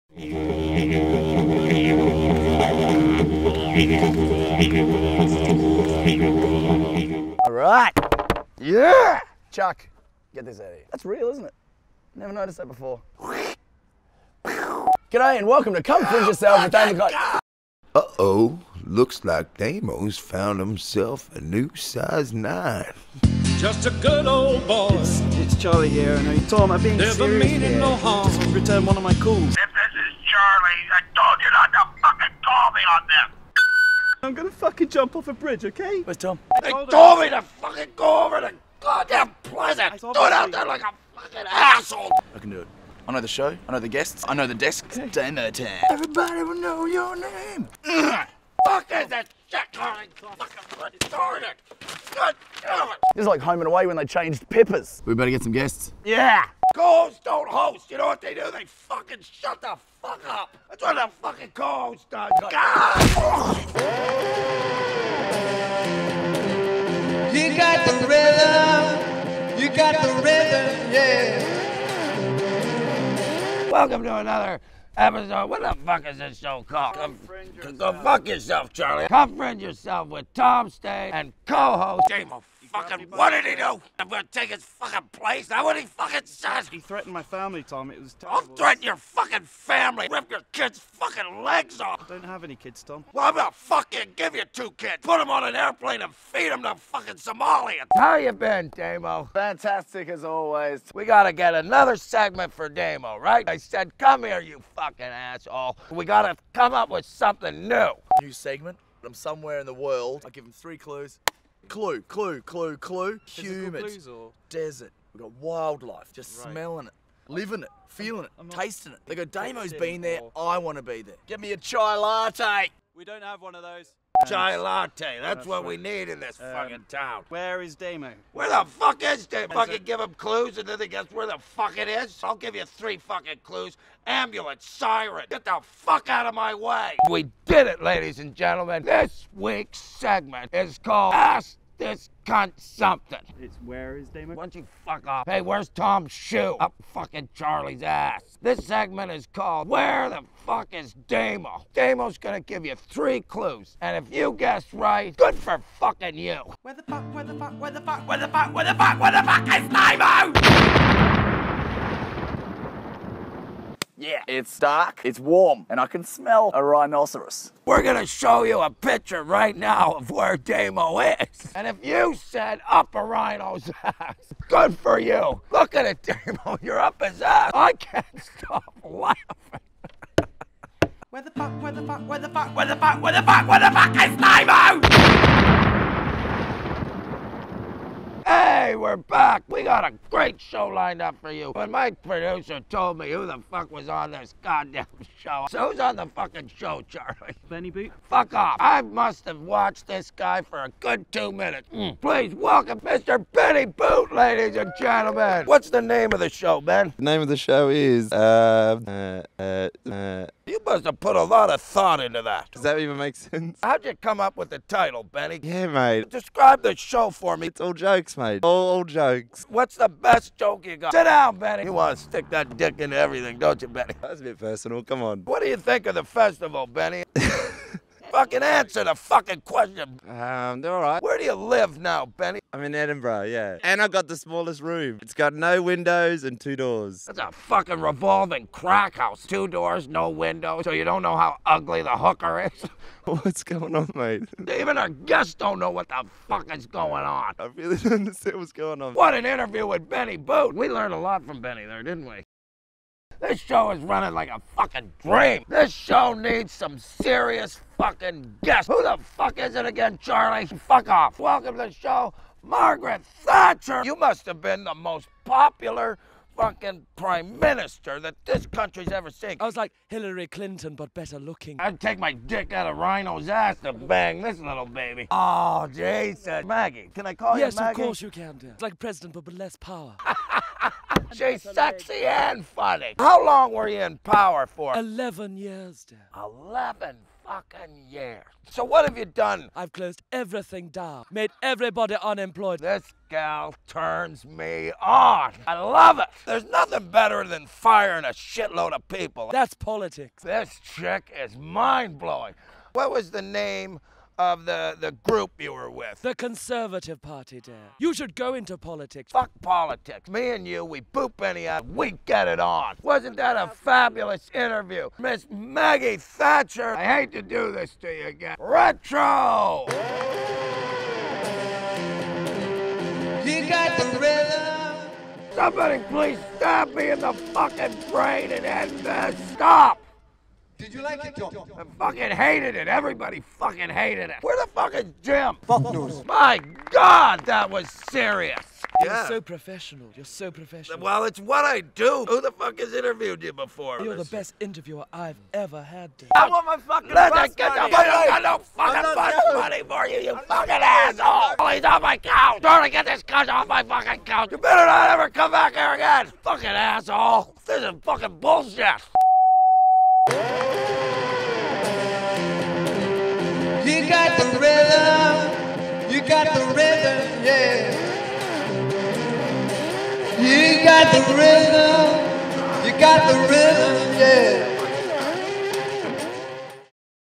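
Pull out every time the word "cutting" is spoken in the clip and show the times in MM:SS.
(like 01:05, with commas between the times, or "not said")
not said.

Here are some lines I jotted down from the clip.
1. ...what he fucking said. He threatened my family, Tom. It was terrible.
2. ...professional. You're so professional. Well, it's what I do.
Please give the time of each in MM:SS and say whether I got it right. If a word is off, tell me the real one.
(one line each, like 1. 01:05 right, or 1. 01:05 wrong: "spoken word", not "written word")
1. 01:25 right
2. 05:39 right.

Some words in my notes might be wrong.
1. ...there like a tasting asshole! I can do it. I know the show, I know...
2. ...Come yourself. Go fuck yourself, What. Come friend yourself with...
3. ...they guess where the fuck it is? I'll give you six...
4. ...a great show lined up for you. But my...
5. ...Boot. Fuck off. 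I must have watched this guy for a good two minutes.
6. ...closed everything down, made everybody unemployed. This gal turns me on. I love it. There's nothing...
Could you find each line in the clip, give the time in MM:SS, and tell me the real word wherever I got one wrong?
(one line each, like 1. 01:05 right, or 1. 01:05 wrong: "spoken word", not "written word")
1. 00:40 wrong: "fucking", not "tasting"
2. 01:17 wrong: "Charlie", not "What"
3. 02:10 wrong: "three", not "six"
4. 03:09 right
5. 03:17 right
6. 04:49 right.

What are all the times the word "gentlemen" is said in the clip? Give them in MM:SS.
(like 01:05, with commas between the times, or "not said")
02:18, 03:24.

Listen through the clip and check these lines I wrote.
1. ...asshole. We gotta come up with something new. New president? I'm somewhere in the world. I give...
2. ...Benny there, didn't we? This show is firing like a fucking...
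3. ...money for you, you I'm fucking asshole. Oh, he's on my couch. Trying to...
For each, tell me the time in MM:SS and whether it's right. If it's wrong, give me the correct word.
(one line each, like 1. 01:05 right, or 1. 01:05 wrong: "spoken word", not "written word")
1. 01:45 wrong: "segment", not "president"
2. 04:11 wrong: "running", not "firing"
3. 05:49 right.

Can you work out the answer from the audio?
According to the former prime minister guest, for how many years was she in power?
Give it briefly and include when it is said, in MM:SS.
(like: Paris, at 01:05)
11, at 04:44.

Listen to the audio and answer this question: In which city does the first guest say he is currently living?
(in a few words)
Edinburgh.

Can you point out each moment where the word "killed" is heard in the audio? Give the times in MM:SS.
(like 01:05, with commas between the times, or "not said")
not said.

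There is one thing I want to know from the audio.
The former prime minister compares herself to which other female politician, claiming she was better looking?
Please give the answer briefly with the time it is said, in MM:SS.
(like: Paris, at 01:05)
Hillary Clinton, at 04:29.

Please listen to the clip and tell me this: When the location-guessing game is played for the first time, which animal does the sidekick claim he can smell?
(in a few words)
rhinoceros.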